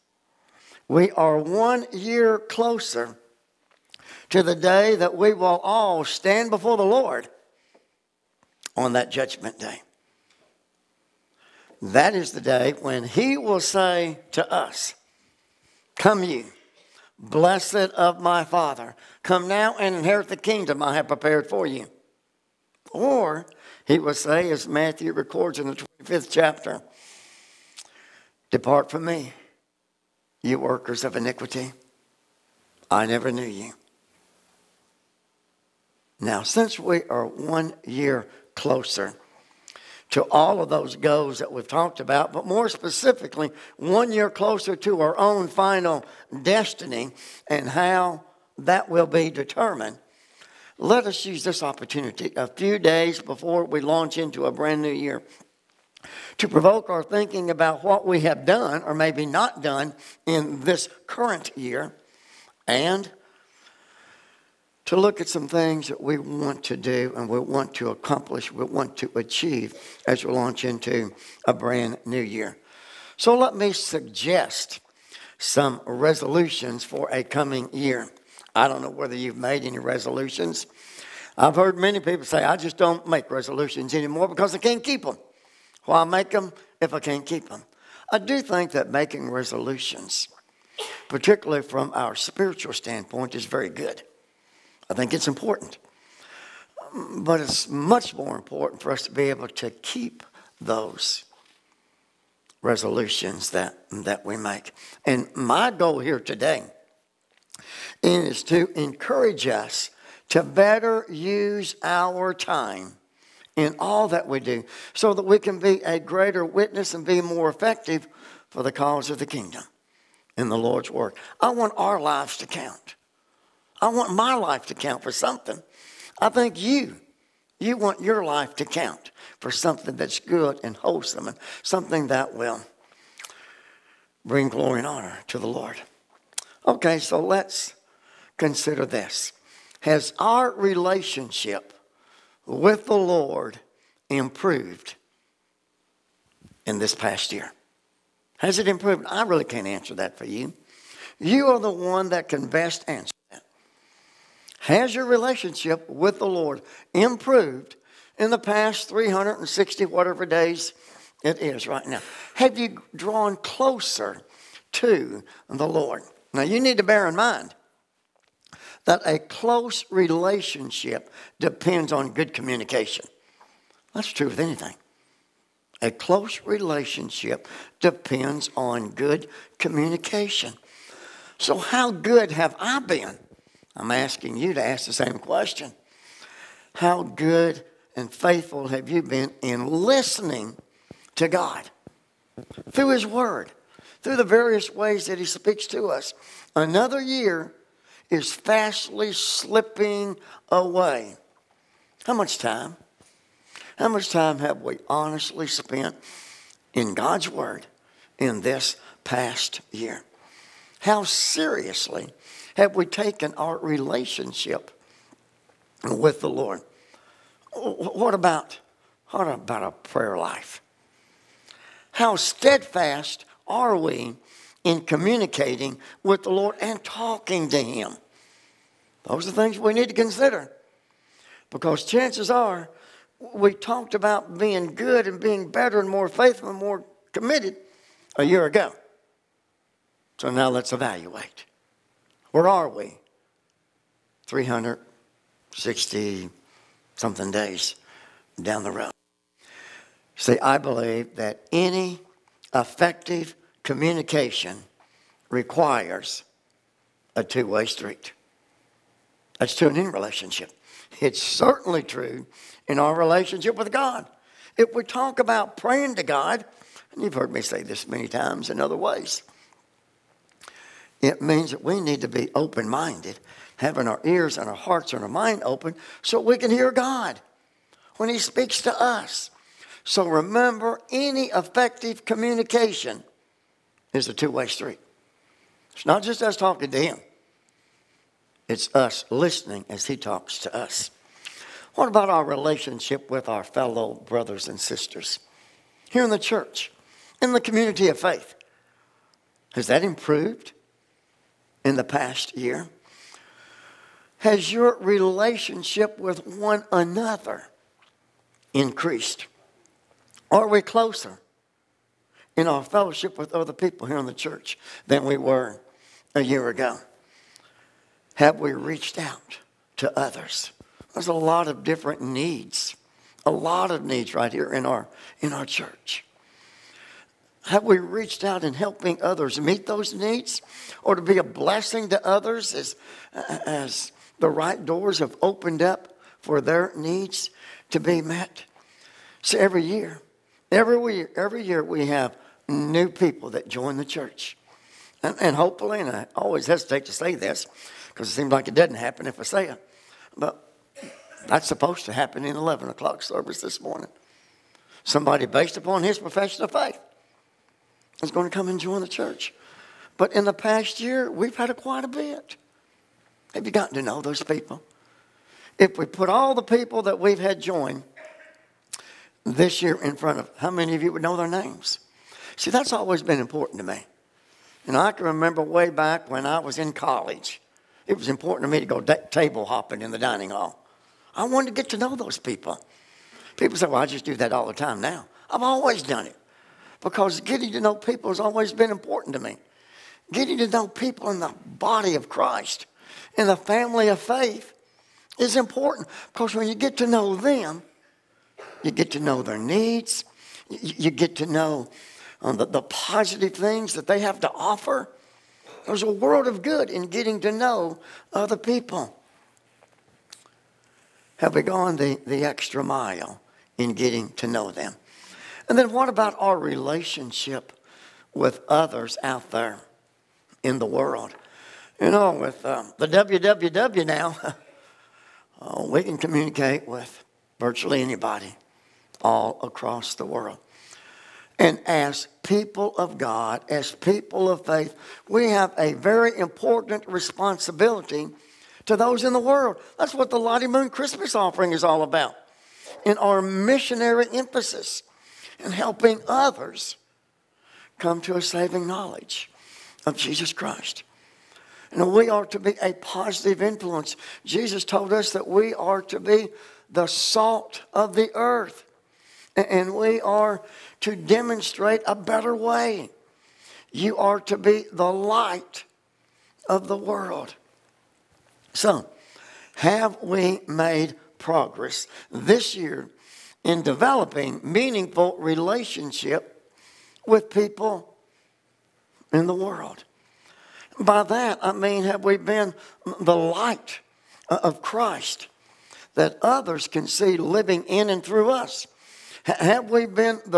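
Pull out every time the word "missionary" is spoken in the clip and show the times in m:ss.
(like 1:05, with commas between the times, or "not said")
7:23.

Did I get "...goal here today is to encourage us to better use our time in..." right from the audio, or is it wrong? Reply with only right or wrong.
right.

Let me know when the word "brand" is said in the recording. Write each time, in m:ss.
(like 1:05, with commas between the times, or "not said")
0:54, 1:11.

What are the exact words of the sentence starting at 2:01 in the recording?
I want our lives to count.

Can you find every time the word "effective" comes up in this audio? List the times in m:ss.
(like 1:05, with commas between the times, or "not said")
1:57, 4:12, 4:41.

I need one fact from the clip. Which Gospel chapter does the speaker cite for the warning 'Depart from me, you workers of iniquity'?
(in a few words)
Matthew 25.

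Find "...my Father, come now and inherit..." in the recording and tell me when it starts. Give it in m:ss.
0:18.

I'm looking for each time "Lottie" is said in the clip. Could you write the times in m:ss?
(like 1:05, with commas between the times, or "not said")
7:20.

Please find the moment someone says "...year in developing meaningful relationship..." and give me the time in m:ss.
7:52.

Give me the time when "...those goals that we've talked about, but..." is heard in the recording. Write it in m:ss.
0:40.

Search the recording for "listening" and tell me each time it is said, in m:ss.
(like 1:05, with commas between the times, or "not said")
3:09, 4:49.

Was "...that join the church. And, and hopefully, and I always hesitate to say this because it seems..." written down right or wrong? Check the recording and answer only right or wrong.
right.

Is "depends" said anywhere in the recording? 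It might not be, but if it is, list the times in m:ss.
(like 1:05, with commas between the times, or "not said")
2:51, 2:57.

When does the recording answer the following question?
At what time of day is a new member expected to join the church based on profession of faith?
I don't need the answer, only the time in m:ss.
5:52.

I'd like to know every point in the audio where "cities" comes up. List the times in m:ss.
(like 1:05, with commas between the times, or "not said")
not said.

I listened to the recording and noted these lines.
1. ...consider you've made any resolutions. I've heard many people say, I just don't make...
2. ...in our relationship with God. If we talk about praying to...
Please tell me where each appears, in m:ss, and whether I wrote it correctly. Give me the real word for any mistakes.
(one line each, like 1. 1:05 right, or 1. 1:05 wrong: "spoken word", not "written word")
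1. 1:18 wrong: "whether", not "consider"
2. 4:22 right.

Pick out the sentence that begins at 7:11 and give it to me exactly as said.
And as people of God, as people of faith, we have a very important responsibility to those in the world.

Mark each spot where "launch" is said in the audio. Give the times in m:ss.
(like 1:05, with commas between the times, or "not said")
0:53, 1:10.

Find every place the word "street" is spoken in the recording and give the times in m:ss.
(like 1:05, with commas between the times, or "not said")
4:17, 4:44.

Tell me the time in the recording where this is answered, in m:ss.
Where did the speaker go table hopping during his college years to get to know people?
6:19.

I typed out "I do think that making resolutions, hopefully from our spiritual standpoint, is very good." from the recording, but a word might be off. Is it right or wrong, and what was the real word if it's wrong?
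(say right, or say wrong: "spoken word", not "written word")
wrong: "particularly", not "hopefully".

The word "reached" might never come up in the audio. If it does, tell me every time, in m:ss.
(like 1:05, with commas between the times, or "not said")
5:18, 5:27.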